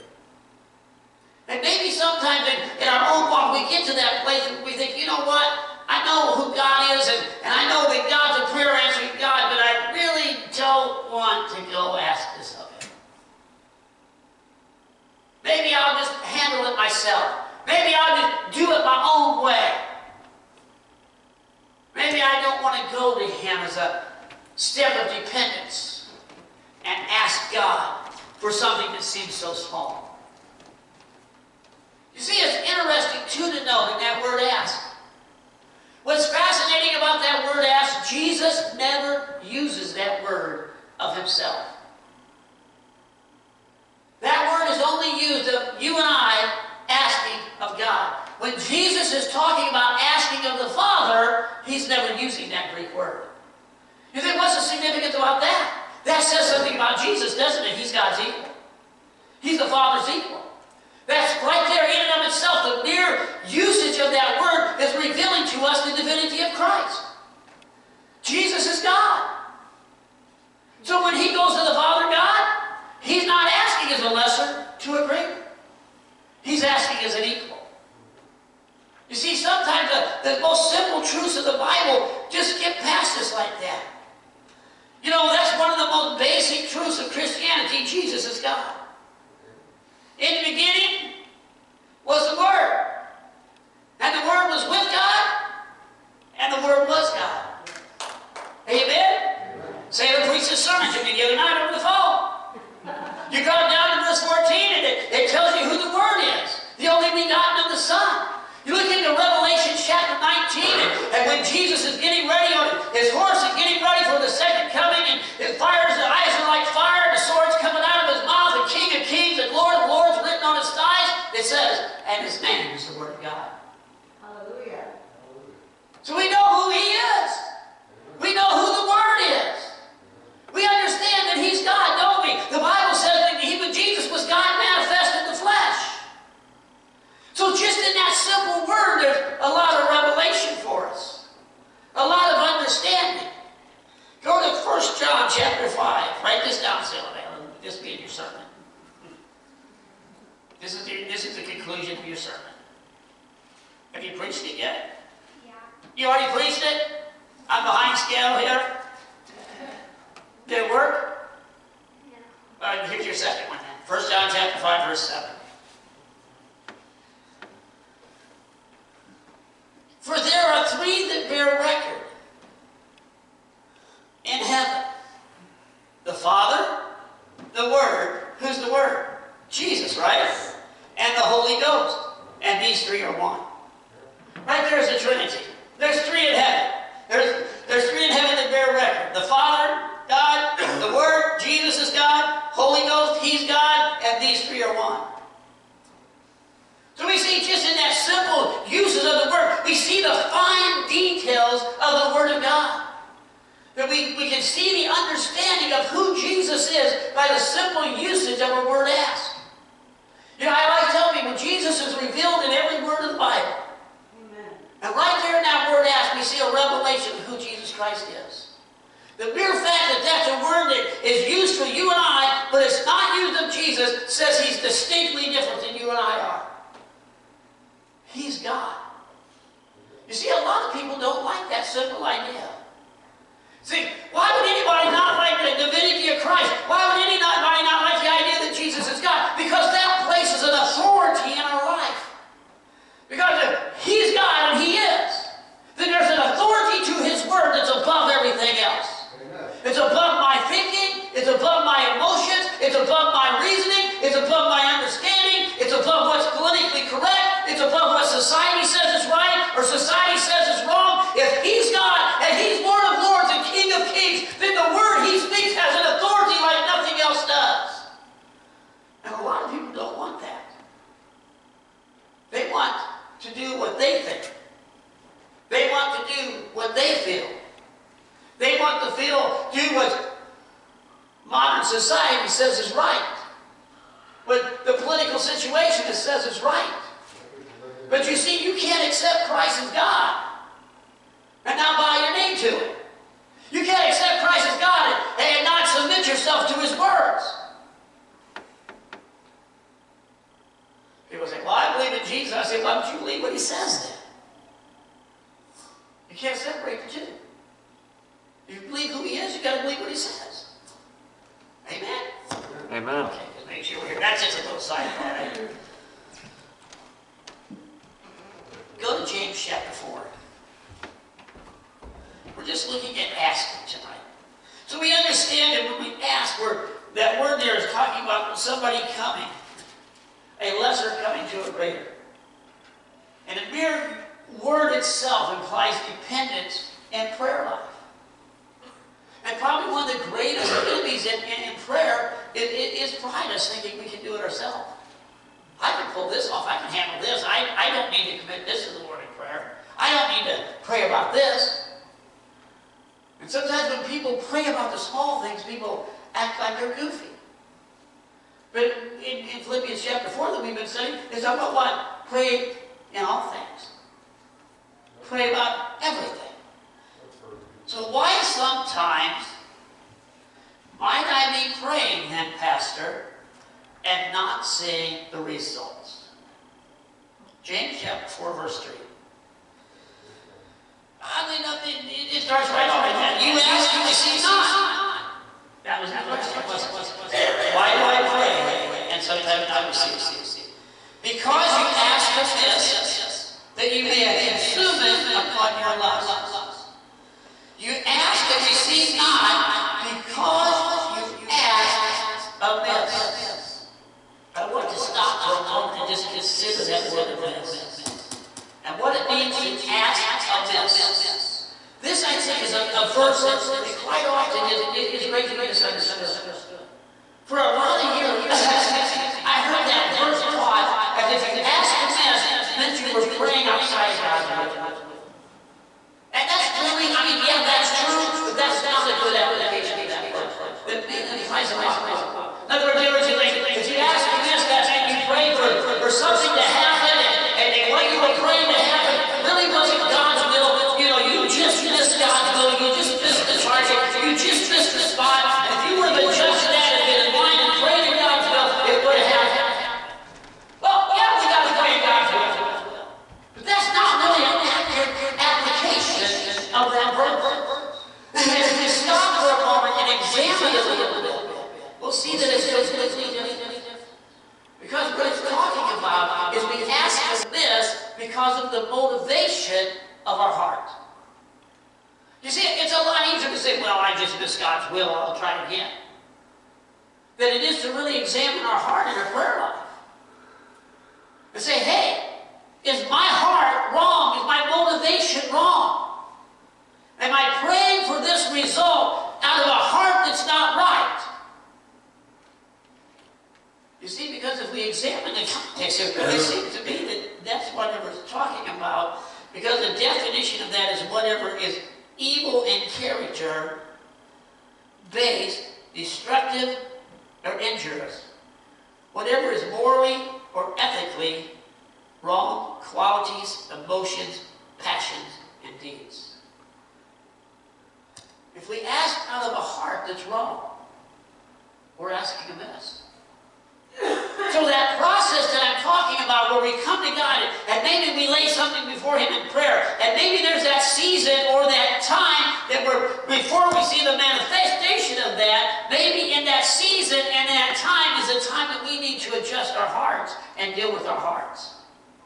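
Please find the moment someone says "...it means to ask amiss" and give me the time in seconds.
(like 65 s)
408 s.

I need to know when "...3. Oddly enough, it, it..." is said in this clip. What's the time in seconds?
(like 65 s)
378 s.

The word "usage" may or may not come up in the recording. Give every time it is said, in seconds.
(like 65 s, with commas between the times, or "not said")
63 s, 208 s.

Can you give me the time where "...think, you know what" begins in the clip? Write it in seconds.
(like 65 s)
4 s.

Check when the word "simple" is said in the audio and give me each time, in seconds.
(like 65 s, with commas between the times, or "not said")
80 s, 138 s, 197 s, 207 s, 231 s.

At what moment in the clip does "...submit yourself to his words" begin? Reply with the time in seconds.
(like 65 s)
295 s.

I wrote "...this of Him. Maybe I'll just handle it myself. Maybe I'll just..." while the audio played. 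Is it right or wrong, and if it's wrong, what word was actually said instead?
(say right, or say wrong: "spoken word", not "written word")
right.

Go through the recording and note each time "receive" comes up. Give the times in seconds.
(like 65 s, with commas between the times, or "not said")
383 s, 389 s, 398 s.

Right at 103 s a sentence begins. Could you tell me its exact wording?
You go down to verse 14, and it, it tells you who the Word is, the only begotten of the Son.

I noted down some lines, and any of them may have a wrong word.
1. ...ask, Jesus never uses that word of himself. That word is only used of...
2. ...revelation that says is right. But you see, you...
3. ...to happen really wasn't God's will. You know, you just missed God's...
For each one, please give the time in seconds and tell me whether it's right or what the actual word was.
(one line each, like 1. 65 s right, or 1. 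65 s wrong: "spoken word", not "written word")
1. 37 s right
2. 285 s wrong: "situation", not "revelation"
3. 438 s right.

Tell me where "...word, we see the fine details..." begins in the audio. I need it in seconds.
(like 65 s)
199 s.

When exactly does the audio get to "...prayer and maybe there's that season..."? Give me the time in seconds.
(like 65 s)
529 s.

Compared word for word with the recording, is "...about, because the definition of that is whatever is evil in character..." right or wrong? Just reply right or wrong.
right.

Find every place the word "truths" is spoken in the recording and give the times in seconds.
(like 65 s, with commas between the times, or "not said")
81 s, 86 s.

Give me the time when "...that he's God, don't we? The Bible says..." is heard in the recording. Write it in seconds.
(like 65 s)
131 s.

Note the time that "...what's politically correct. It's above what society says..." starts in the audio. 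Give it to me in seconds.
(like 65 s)
256 s.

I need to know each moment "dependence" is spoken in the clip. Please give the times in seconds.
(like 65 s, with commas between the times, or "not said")
25 s.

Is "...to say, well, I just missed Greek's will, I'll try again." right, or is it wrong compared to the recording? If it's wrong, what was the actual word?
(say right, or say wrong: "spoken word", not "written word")
wrong: "God", not "Greek".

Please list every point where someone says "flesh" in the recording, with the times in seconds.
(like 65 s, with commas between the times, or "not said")
135 s.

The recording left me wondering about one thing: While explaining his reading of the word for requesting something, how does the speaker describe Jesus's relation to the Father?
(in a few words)
The Father's equal.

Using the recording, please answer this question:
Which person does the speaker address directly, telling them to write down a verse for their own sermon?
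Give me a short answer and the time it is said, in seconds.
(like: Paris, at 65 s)
Sylvan, at 146 s.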